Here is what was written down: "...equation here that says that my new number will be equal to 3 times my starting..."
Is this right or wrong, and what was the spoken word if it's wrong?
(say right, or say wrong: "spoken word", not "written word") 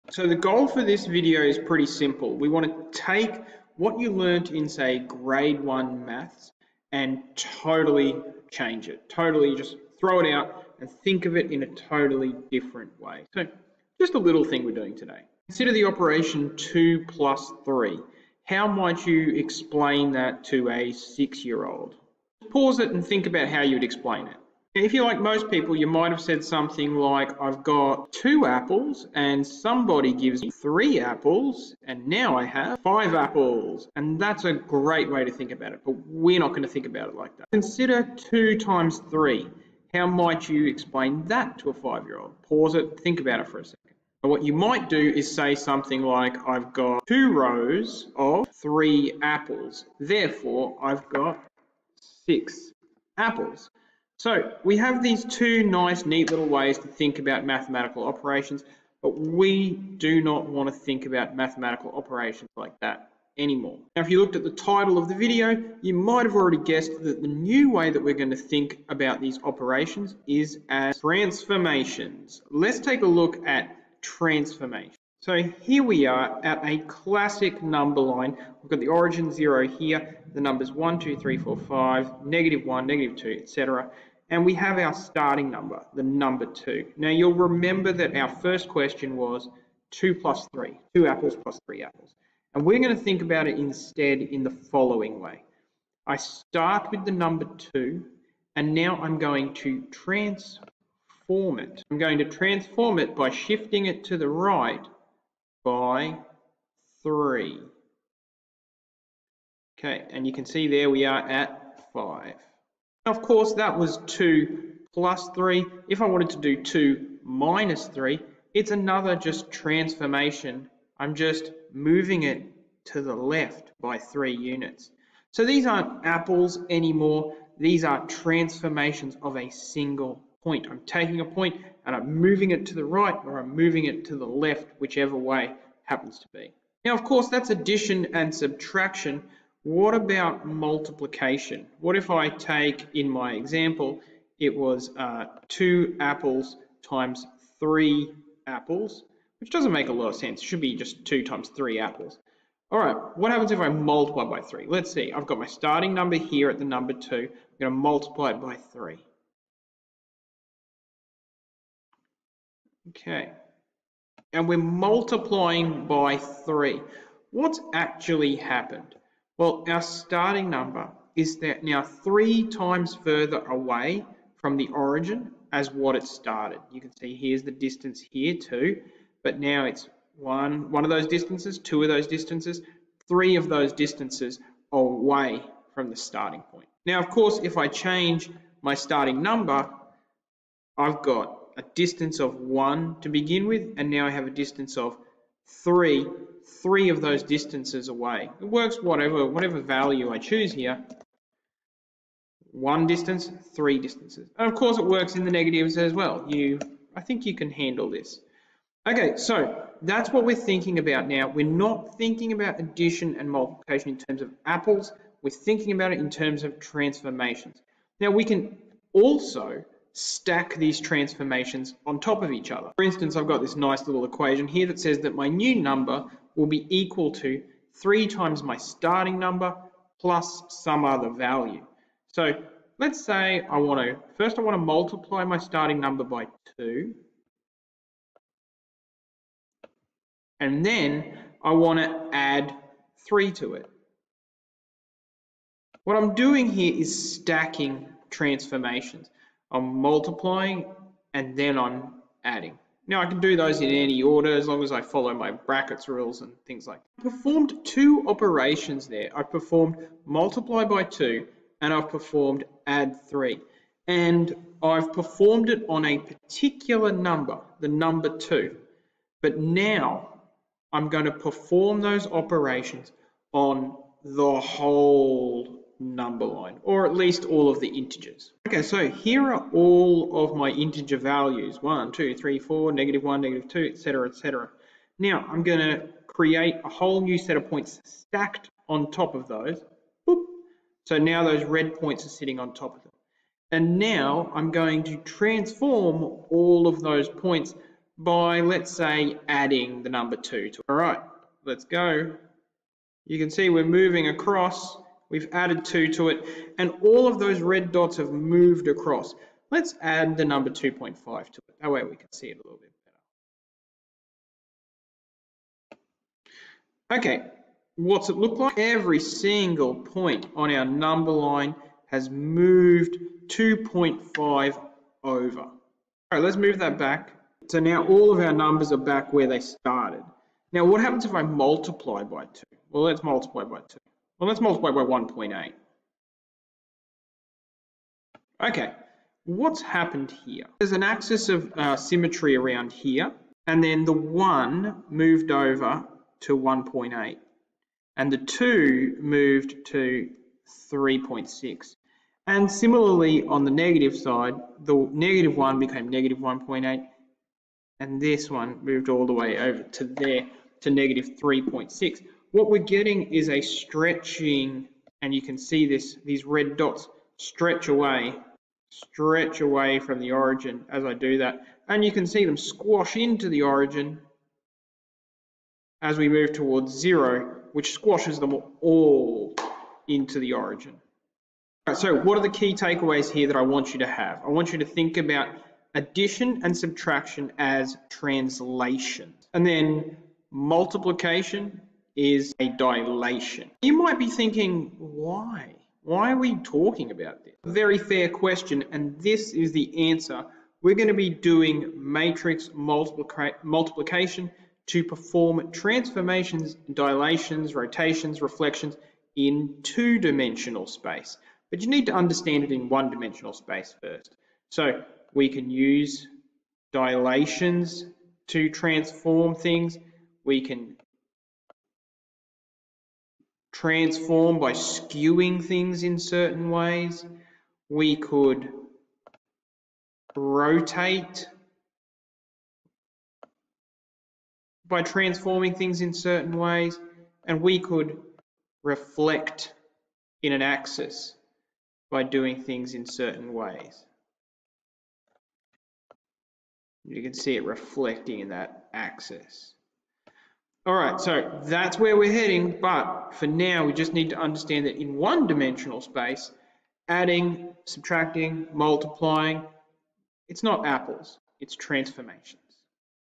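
right.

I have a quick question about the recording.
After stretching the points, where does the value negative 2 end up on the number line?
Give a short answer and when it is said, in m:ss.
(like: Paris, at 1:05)
-3.6, at 6:00.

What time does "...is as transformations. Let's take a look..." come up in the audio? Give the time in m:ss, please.
1:10.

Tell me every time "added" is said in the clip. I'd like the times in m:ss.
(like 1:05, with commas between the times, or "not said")
5:05.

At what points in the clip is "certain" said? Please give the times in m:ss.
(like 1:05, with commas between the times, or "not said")
7:05, 7:15, 7:22.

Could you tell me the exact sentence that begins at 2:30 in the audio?
It should be just two times three apples.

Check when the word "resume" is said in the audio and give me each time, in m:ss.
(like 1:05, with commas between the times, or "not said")
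not said.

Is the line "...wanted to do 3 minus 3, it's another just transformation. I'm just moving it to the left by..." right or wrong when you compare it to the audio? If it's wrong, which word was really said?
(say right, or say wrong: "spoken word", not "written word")
wrong: "2", not "3".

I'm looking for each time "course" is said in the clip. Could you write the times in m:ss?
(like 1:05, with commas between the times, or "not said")
1:53, 2:17, 3:07, 3:24.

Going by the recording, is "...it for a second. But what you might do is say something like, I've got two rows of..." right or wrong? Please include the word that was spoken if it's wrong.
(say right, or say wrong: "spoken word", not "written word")
right.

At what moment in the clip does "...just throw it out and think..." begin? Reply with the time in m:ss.
0:09.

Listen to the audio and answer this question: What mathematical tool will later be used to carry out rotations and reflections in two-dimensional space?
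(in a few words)
Matrix multiplication.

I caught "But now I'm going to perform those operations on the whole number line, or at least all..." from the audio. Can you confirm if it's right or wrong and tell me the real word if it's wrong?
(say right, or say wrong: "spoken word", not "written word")
right.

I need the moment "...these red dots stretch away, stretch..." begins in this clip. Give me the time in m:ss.
6:06.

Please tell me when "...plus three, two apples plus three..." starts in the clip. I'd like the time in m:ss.
1:30.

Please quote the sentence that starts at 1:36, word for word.
I start with the number two, and now I'm going to transform it.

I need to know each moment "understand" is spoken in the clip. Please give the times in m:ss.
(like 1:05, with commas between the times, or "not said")
6:51, 7:34.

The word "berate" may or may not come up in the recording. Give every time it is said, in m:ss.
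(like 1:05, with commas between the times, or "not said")
not said.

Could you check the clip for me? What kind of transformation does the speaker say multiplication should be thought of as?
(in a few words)
Dilation.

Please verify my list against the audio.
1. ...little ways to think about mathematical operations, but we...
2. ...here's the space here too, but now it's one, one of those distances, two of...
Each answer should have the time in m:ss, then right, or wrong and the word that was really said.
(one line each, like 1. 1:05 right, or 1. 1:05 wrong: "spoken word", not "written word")
1. 0:56 right
2. 2:57 wrong: "distance", not "space".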